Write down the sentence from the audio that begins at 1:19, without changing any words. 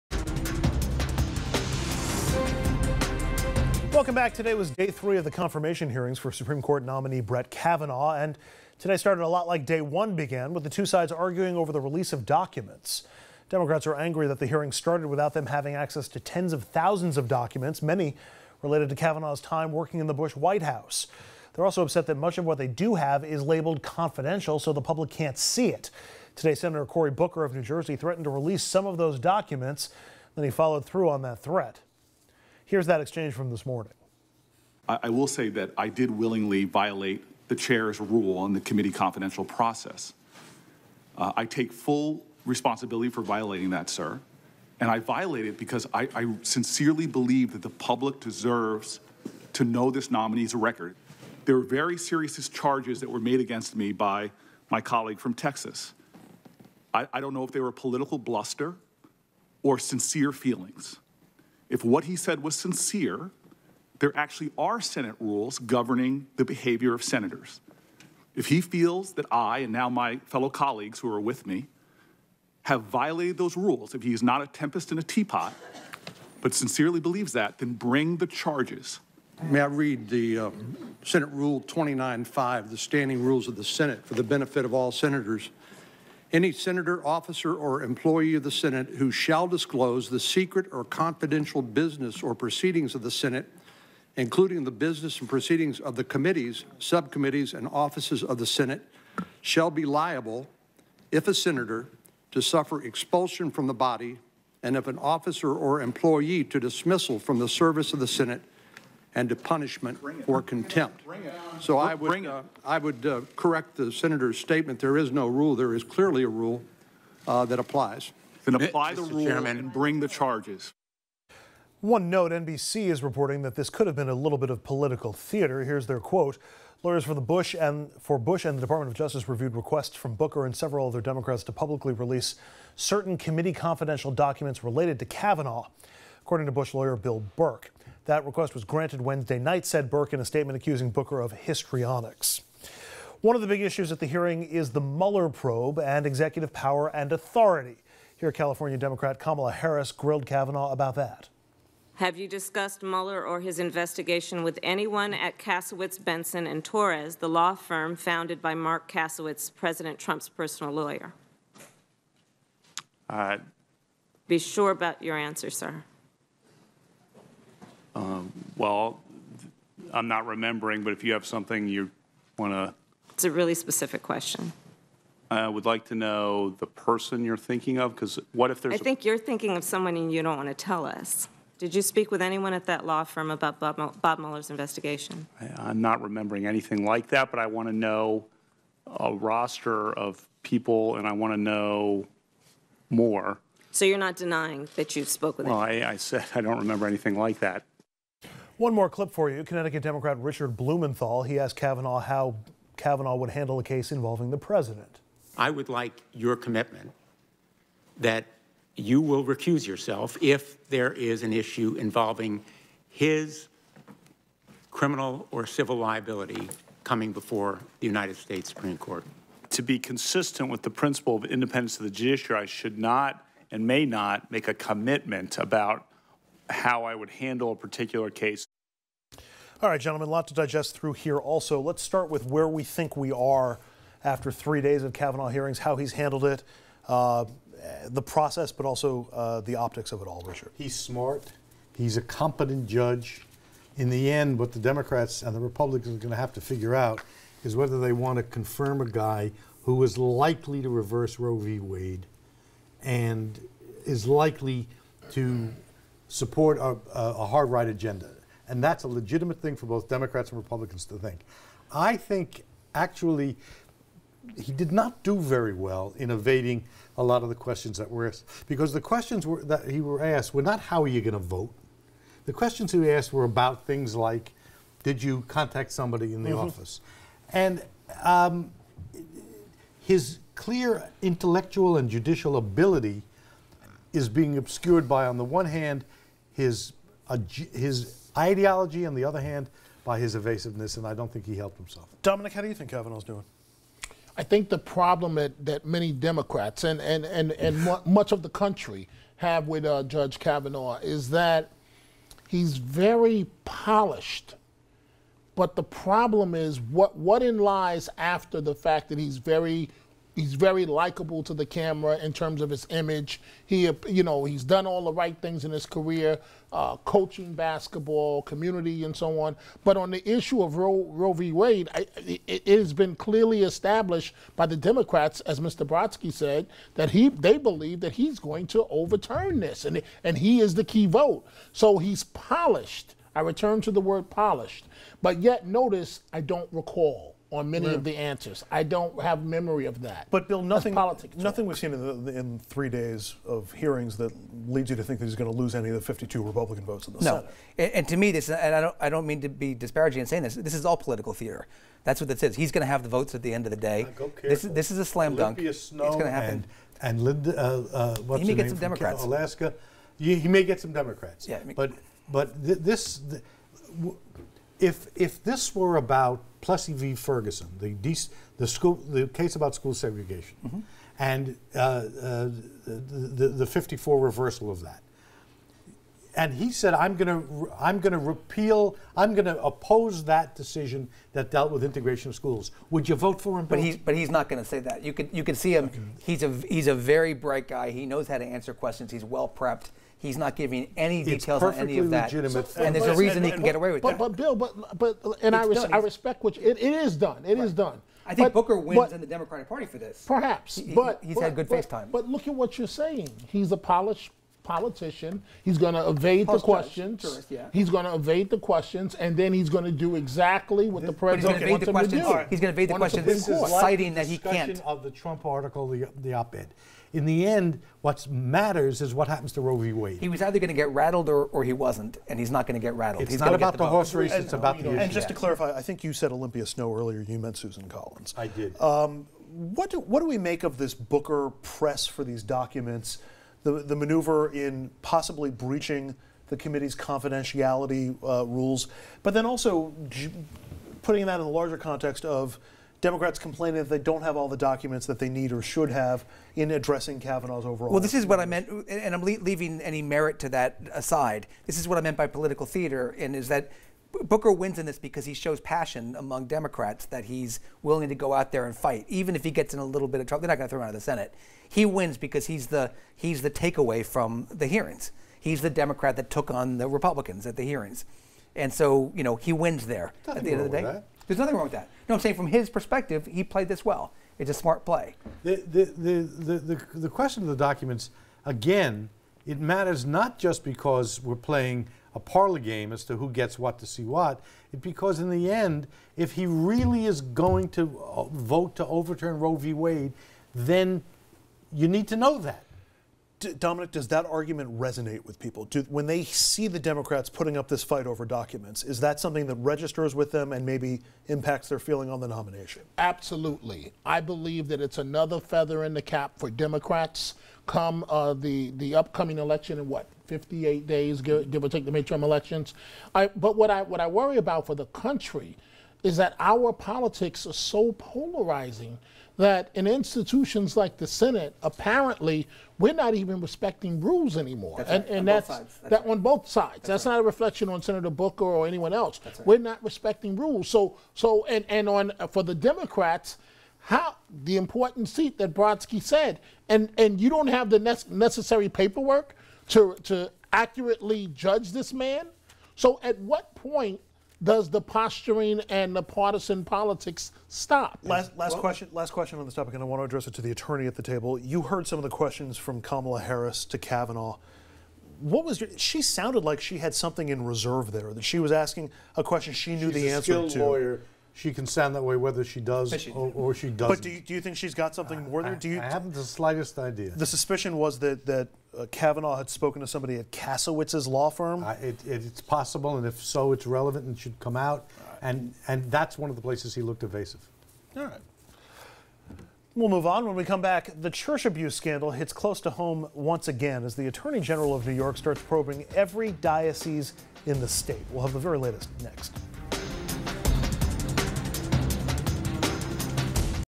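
May I read the um, Senate Rule 29.5, the standing rules of the Senate for the benefit of all senators?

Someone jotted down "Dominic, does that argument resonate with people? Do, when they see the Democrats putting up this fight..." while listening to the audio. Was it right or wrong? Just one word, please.
right.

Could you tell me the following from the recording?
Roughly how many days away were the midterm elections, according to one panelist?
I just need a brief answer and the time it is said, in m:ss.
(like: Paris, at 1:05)
58, at 8:30.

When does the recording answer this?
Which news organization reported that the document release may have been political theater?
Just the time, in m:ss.
2:02.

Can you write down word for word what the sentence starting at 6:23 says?
But he's but he's not going to say that.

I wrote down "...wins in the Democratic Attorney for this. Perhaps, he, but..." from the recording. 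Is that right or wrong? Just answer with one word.
wrong.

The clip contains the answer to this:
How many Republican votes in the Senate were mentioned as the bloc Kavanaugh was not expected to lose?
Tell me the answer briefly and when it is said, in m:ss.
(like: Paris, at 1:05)
52, at 5:45.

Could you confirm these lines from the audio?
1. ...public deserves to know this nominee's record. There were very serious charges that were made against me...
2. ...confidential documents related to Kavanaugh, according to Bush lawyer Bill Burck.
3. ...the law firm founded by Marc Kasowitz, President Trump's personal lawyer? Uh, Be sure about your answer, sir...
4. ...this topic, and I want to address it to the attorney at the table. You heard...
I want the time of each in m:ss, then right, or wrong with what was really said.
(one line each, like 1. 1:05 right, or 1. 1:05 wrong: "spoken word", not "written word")
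1. 0:47 right
2. 2:13 right
3. 2:37 right
4. 9:09 right.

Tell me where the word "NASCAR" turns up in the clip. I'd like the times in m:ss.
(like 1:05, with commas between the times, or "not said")
not said.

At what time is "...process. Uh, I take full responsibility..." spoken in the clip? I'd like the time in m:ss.
0:39.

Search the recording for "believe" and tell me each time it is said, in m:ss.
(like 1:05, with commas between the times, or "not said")
0:47, 1:16, 5:27, 8:24.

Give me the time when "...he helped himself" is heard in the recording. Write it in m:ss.
4:51.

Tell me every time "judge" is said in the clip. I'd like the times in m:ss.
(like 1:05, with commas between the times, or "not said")
4:02, 4:59, 9:01.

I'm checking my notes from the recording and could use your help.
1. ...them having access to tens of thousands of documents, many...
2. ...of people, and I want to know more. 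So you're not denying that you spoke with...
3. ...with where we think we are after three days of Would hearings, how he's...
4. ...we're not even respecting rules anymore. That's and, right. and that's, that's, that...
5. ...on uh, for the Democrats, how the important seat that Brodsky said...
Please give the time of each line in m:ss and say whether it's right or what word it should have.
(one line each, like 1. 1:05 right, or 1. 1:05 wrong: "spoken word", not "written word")
1. 0:15 right
2. 3:09 right
3. 3:52 wrong: "Kavanaugh", not "Would"
4. 8:42 right
5. 8:51 right.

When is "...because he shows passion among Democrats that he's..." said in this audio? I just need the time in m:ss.
7:34.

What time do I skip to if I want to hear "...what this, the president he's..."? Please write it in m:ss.
6:50.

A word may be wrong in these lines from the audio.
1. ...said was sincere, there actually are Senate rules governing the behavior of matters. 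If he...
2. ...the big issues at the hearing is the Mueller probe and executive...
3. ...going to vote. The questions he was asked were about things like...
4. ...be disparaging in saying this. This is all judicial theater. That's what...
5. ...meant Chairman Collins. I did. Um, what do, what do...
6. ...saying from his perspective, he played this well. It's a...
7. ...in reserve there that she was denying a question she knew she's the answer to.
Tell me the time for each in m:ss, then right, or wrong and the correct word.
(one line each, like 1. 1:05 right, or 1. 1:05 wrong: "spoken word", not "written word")
1. 1:02 wrong: "senators", not "matters"
2. 2:23 right
3. 4:30 right
4. 5:49 wrong: "political", not "judicial"
5. 7:07 wrong: "Susan", not "Chairman"
6. 7:52 right
7. 9:17 wrong: "asking", not "denying".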